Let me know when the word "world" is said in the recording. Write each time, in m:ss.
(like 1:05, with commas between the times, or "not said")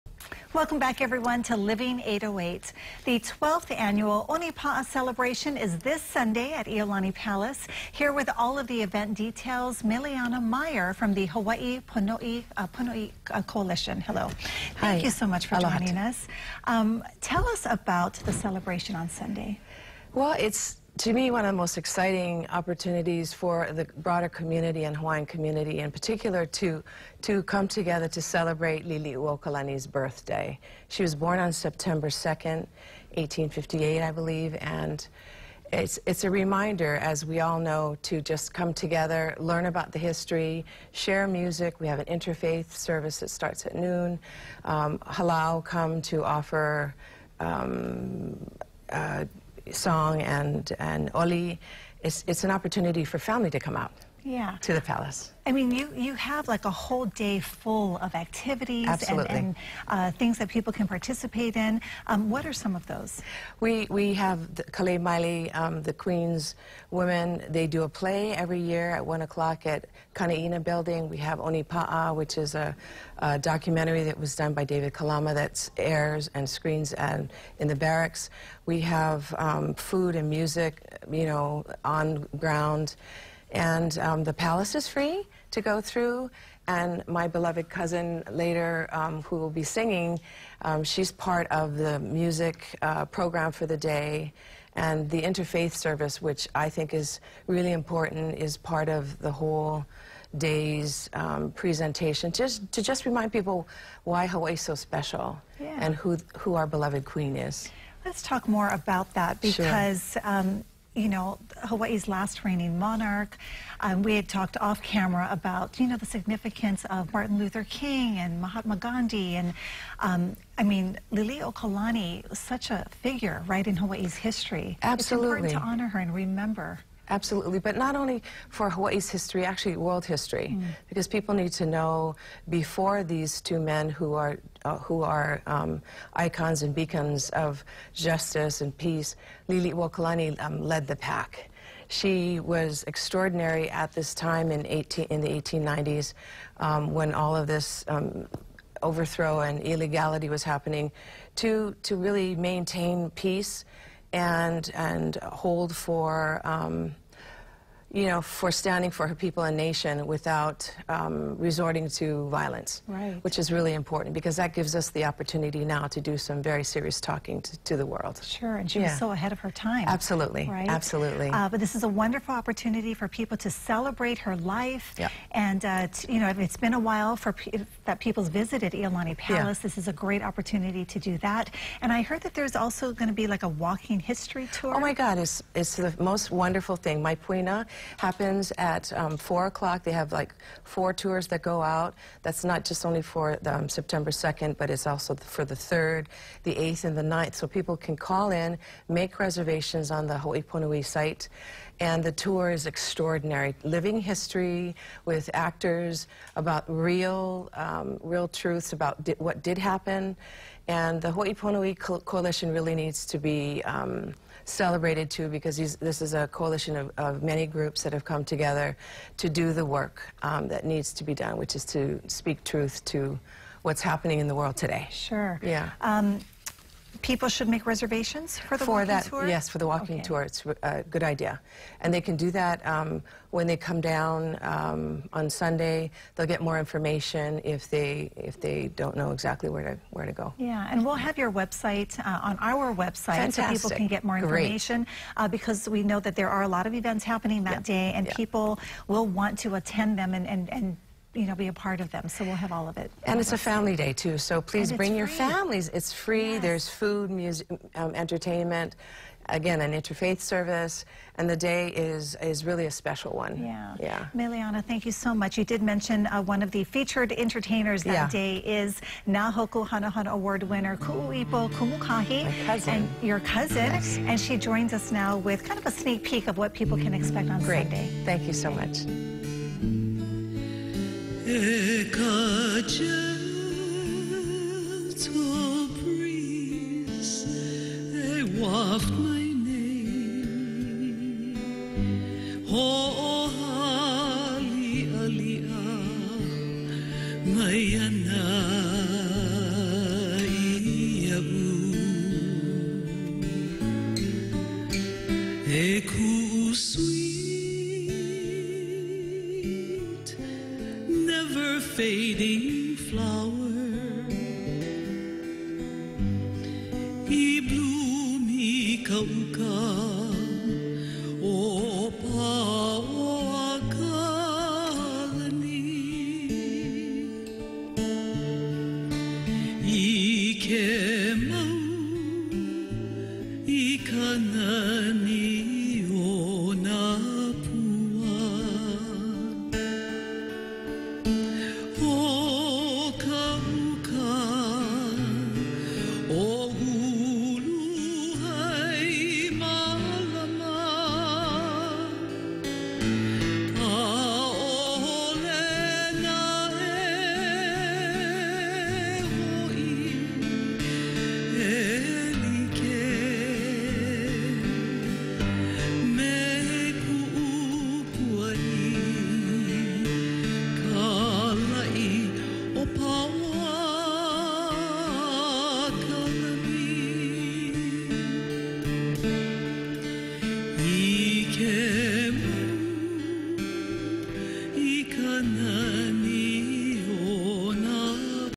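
2:09, 2:47, 3:44.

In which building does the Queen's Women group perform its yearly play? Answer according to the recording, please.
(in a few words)
Kanaina Building.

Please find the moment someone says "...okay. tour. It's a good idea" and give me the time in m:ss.
3:49.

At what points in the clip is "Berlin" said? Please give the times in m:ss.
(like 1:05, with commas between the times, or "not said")
not said.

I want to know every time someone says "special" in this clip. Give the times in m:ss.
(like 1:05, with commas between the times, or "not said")
1:44, 4:22.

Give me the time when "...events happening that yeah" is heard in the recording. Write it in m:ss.
4:06.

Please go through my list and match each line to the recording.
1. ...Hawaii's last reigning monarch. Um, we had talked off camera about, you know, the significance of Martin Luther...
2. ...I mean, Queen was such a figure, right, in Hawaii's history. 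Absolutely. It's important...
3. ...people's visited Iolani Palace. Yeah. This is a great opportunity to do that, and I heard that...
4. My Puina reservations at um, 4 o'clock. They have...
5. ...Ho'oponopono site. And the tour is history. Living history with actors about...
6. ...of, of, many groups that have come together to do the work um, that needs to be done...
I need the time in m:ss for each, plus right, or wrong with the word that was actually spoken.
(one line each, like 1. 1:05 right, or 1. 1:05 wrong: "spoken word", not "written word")
1. 1:51 right
2. 2:00 wrong: "Lili", not "Queen"
3. 2:57 right
4. 3:07 wrong: "happens", not "reservations"
5. 3:20 wrong: "extraordinary", not "history"
6. 3:36 right.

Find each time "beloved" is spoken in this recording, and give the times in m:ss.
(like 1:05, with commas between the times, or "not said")
1:27, 1:46.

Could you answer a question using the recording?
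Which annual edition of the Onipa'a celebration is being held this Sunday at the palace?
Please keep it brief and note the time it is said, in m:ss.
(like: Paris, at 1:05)
12th, at 0:03.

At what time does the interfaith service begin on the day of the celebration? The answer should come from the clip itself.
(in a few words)
noon.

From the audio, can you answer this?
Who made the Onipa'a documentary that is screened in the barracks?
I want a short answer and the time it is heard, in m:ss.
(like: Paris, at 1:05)
David Kalama, at 1:14.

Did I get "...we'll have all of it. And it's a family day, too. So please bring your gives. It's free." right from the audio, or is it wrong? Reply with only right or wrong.
wrong.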